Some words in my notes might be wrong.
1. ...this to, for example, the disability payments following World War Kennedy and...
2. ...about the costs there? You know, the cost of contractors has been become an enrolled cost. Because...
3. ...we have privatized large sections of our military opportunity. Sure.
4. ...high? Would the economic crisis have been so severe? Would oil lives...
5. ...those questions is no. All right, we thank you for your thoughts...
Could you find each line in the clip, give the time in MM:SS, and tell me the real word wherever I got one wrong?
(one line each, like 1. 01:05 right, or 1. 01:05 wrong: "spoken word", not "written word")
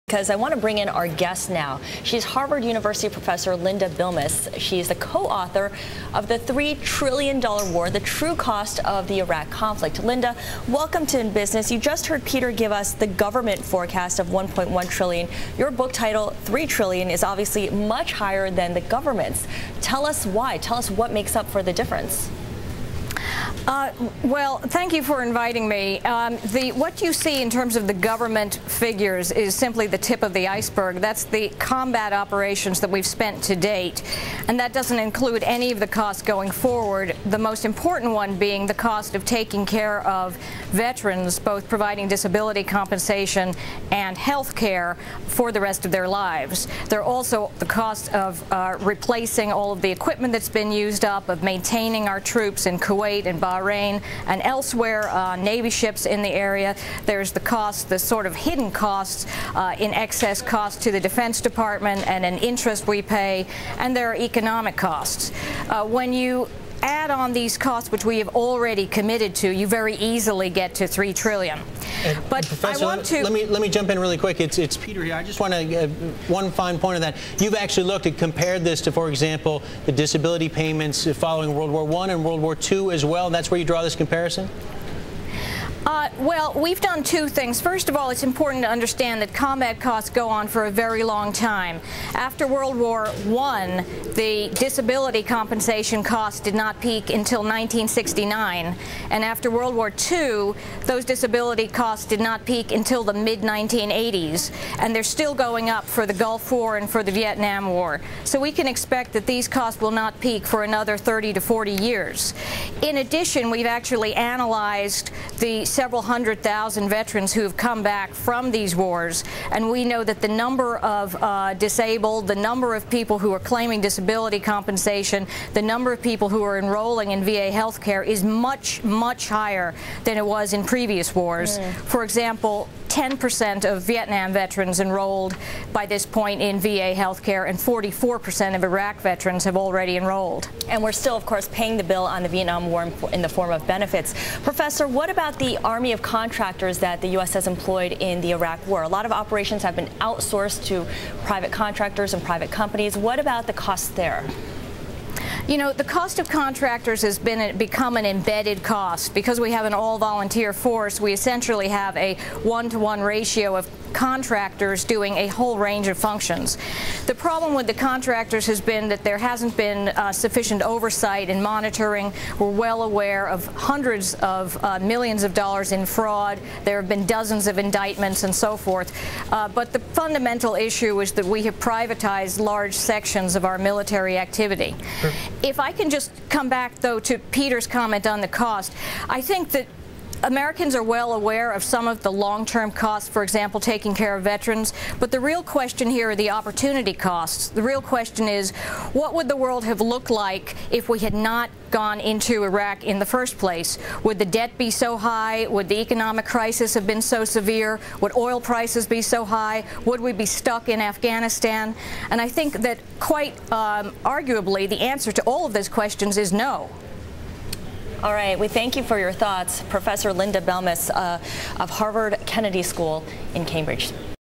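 1. 01:18 wrong: "One", not "Kennedy"
2. 02:33 wrong: "embedded", not "enrolled"
3. 03:01 wrong: "activity", not "opportunity"
4. 03:24 wrong: "prices", not "lives"
5. 03:35 right.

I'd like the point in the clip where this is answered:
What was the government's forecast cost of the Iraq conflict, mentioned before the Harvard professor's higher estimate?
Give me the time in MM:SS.
00:14.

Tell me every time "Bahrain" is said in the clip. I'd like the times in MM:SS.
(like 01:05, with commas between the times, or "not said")
00:53.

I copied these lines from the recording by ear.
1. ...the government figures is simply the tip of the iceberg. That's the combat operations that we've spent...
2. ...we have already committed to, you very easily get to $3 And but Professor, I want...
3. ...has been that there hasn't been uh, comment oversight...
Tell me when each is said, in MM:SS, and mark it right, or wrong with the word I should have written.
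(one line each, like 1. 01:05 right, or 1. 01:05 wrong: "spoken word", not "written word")
1. 00:27 right
2. 01:08 right
3. 02:48 wrong: "sufficient", not "comment".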